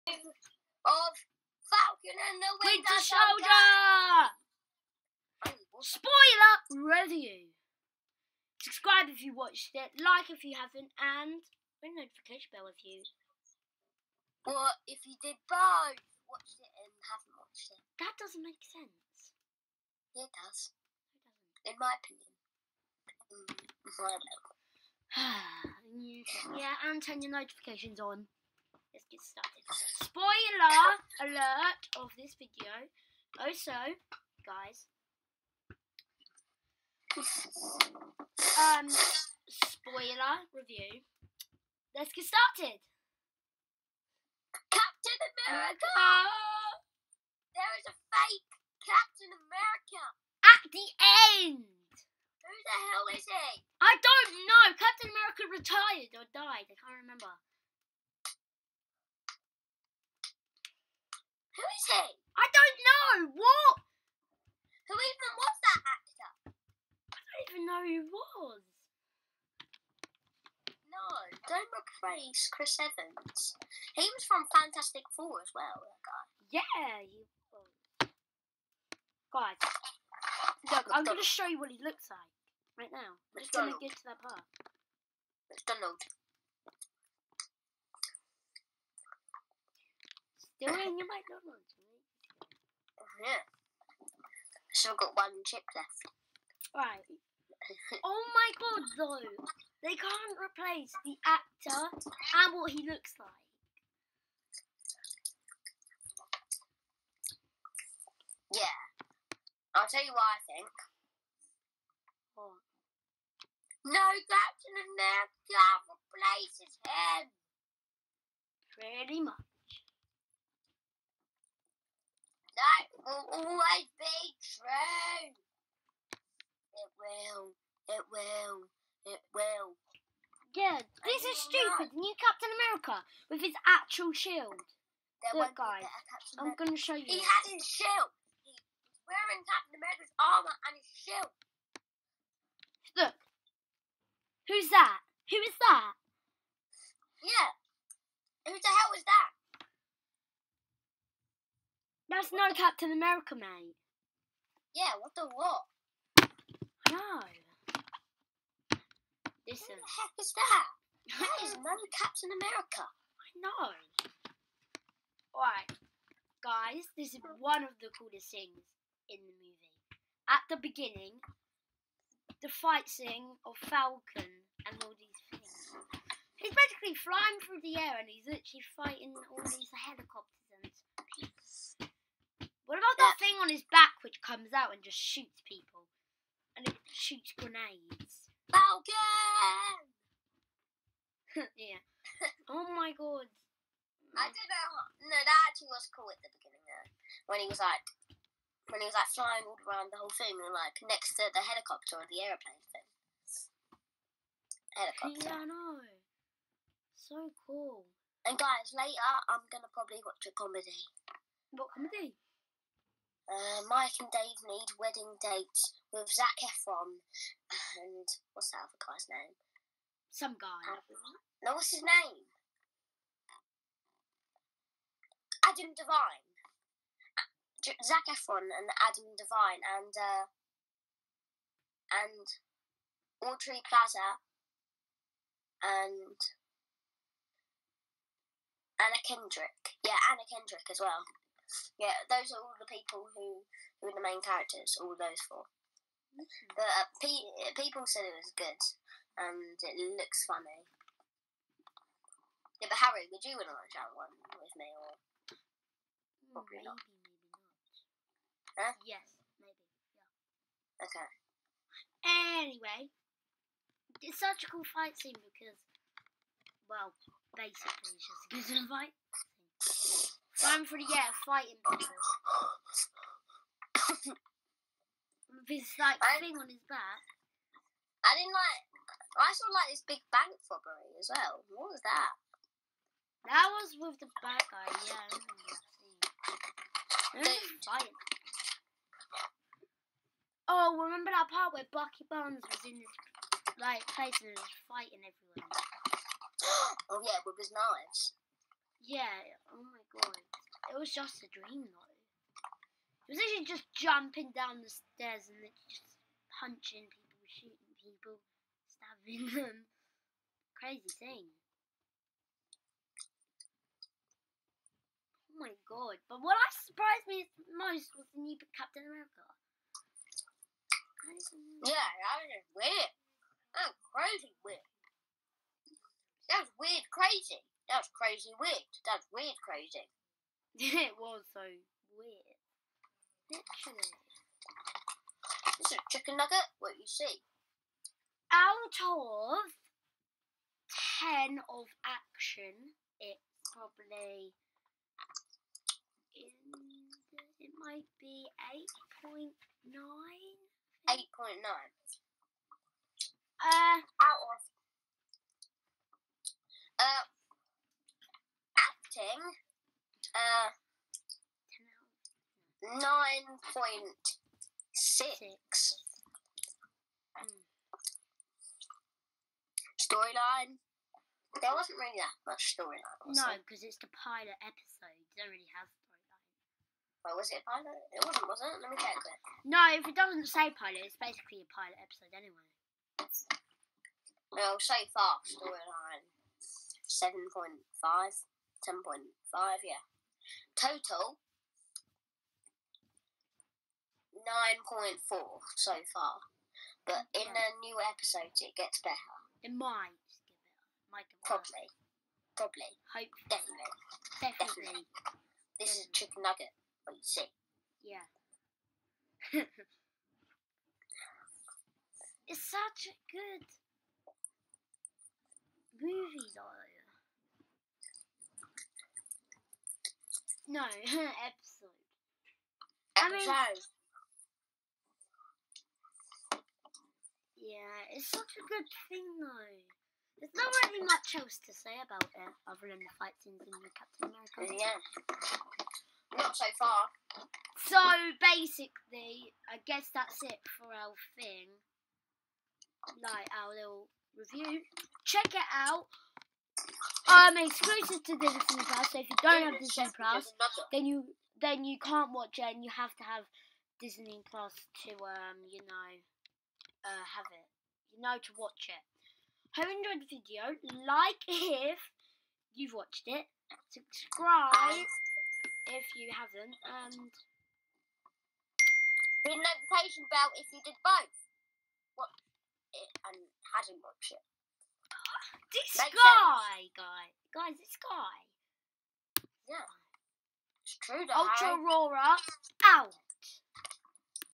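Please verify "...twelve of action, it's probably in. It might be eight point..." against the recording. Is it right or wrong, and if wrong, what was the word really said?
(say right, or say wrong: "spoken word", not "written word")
wrong: "ten", not "twelve".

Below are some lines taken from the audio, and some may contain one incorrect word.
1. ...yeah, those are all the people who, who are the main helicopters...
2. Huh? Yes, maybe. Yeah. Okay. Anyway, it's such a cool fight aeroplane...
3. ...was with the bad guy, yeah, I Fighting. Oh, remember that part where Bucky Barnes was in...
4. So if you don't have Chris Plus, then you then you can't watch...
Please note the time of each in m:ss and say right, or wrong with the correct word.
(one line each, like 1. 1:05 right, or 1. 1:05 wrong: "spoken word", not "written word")
1. 4:01 wrong: "characters", not "helicopters"
2. 4:18 wrong: "scene", not "aeroplane"
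3. 4:43 right
4. 7:28 wrong: "Disney", not "Chris".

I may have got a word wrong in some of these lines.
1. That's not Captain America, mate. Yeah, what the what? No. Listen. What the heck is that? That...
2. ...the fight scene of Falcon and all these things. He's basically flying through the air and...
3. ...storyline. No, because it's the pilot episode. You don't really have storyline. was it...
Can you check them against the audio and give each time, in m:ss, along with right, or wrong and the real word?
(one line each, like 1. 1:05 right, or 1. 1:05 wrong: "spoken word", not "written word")
1. 2:32 right
2. 2:52 right
3. 6:12 right.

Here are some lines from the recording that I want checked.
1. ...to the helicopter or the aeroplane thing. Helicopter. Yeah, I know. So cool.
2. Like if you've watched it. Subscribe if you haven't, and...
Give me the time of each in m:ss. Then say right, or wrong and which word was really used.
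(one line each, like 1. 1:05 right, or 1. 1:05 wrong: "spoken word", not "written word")
1. 3:21 right
2. 7:40 right.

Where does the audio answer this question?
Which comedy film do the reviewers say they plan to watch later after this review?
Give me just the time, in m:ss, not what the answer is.
3:33.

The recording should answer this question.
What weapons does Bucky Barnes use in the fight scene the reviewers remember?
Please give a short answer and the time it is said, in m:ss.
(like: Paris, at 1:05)
knives, at 4:57.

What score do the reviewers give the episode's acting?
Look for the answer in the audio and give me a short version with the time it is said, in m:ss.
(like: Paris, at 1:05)
9.6, at 6:02.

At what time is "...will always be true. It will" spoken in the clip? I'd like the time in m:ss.
2:03.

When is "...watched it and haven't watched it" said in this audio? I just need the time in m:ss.
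0:16.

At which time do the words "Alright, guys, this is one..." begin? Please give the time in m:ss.
2:45.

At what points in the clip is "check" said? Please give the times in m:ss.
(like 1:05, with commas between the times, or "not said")
6:18, 7:25.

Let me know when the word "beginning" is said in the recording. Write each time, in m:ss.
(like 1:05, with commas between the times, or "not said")
2:50, 3:16.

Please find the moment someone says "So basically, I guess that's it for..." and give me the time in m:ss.
7:17.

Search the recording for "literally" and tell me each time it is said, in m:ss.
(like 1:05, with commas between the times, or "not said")
2:58, 5:33.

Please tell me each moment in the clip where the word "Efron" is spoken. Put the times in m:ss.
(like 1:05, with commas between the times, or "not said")
3:36, 3:48.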